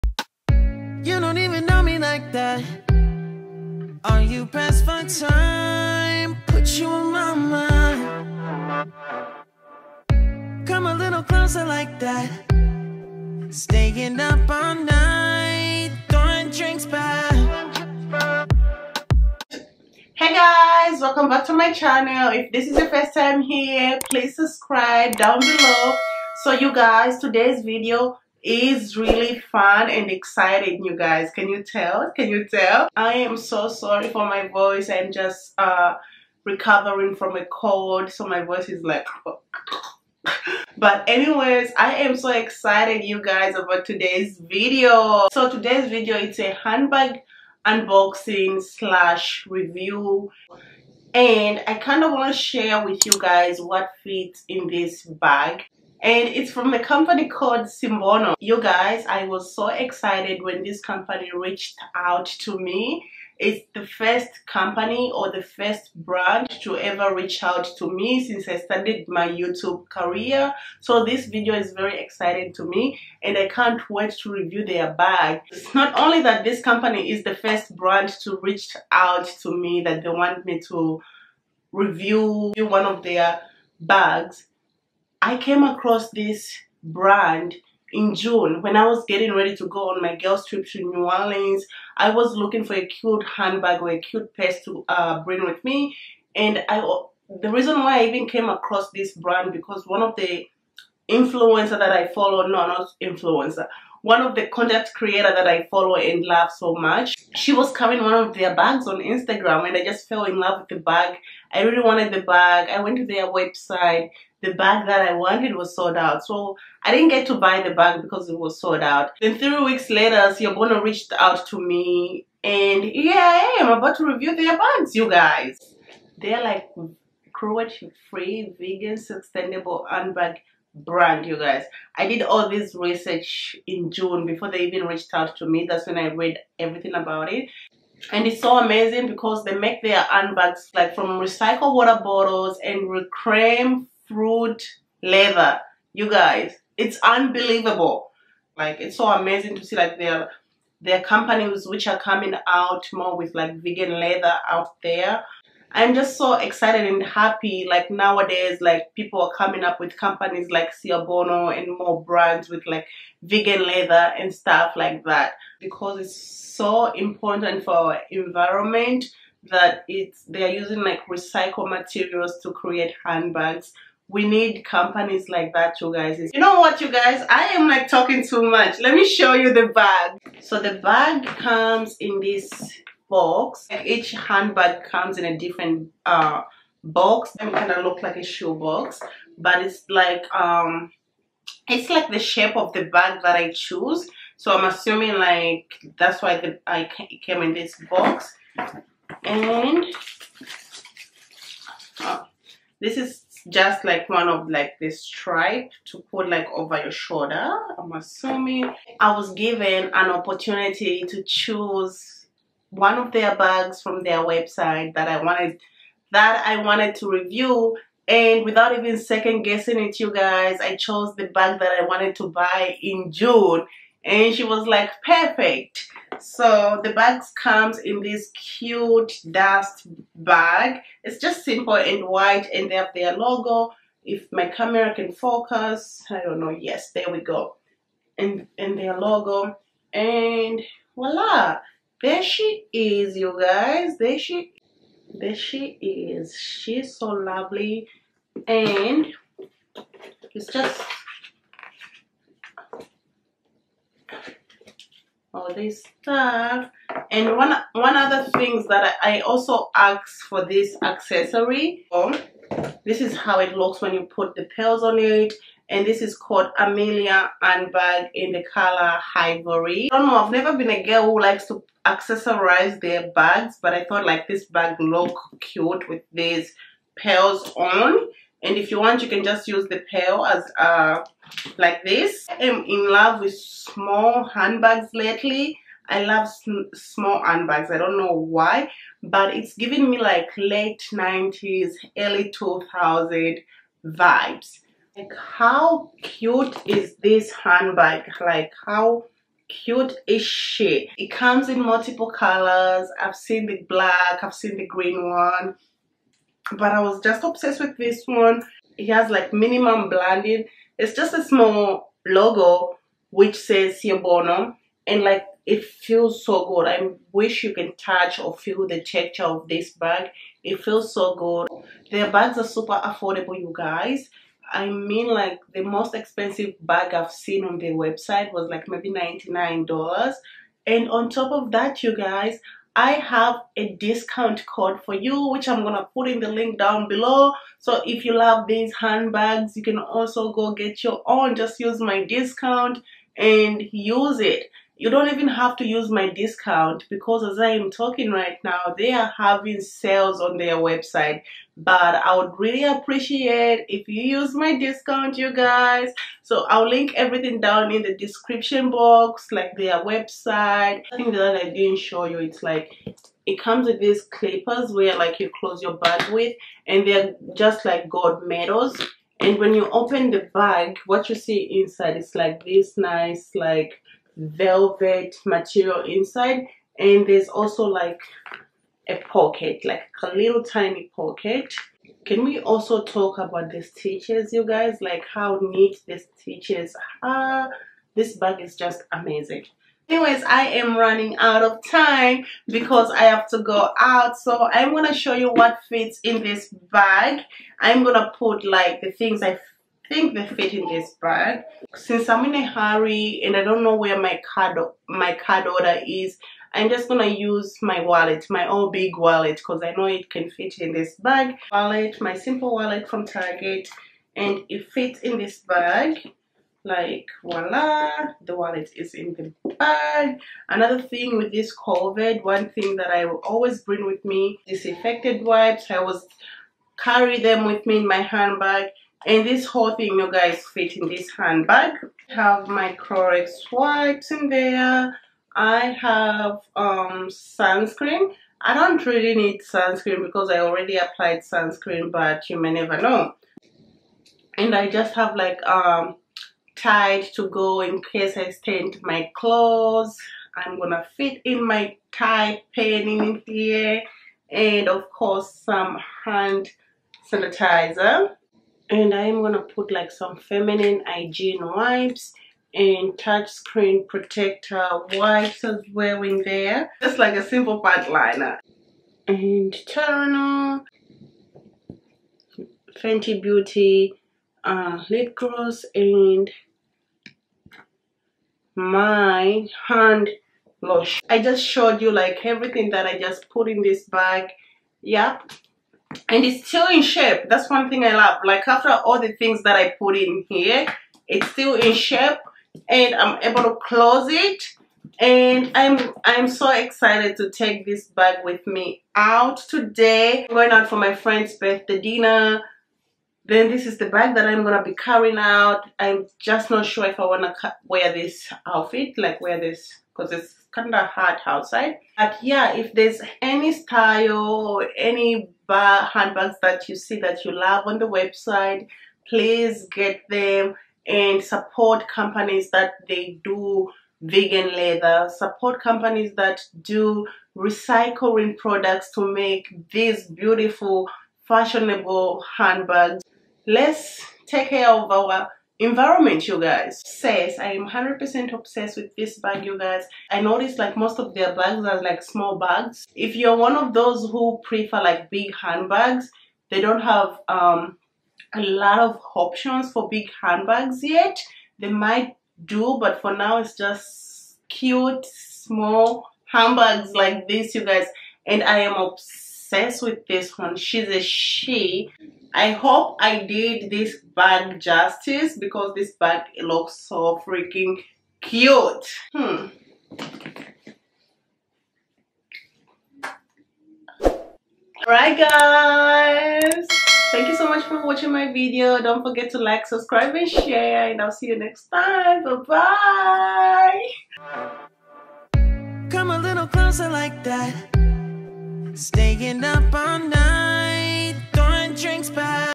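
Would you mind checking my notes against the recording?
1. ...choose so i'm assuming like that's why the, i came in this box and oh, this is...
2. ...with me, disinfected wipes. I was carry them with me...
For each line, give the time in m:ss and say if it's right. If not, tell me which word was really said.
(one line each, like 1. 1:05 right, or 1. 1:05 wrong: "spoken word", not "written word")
1. 3:13 right
2. 7:03 right.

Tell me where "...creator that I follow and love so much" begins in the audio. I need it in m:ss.
1:44.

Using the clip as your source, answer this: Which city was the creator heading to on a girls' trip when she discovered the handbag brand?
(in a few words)
New Orleans.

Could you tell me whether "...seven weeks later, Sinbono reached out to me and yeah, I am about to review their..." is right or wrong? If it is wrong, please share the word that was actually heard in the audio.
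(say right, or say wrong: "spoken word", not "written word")
wrong: "three", not "seven".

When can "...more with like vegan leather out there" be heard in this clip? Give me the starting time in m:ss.
2:32.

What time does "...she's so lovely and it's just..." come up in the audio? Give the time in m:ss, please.
4:06.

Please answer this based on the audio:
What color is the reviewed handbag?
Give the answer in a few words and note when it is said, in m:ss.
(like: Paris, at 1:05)
Ivory, at 4:29.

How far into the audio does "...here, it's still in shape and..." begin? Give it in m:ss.
8:10.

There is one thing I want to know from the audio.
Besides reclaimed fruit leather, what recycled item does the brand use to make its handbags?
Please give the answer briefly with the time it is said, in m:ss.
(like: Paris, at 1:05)
Water bottles, at 2:21.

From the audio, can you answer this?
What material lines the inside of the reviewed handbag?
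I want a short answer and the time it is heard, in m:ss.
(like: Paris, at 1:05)
Velvet, at 6:14.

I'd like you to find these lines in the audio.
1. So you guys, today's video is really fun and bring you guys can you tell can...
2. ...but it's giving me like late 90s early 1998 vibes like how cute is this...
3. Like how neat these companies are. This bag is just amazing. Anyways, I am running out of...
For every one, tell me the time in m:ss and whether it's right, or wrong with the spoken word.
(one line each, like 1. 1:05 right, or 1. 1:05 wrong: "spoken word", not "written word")
1. 0:26 wrong: "exciting", not "bring"
2. 4:49 wrong: "2000", not "1998"
3. 6:24 wrong: "stitches", not "companies".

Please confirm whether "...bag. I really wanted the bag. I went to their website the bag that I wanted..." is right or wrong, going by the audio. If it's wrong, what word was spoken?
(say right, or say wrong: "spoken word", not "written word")
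right.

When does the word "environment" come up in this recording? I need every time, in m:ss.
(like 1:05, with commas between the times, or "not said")
2:48, 8:55.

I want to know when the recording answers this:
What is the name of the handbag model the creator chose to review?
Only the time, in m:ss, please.
4:26.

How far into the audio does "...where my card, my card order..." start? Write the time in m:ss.
6:43.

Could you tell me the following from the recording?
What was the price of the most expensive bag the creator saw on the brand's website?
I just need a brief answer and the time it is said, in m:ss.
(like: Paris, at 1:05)
$99, at 5:28.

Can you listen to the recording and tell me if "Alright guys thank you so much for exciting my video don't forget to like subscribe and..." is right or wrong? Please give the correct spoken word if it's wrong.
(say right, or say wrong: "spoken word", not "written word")
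wrong: "watching", not "exciting".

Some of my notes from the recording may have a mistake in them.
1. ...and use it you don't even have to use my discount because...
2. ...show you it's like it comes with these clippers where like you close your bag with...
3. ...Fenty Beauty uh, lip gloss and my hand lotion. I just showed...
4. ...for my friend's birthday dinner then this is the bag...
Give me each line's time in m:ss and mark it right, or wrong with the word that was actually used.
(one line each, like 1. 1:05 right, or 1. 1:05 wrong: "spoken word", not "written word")
1. 5:43 right
2. 6:01 right
3. 7:52 right
4. 8:20 right.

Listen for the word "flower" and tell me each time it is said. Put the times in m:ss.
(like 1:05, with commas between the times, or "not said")
not said.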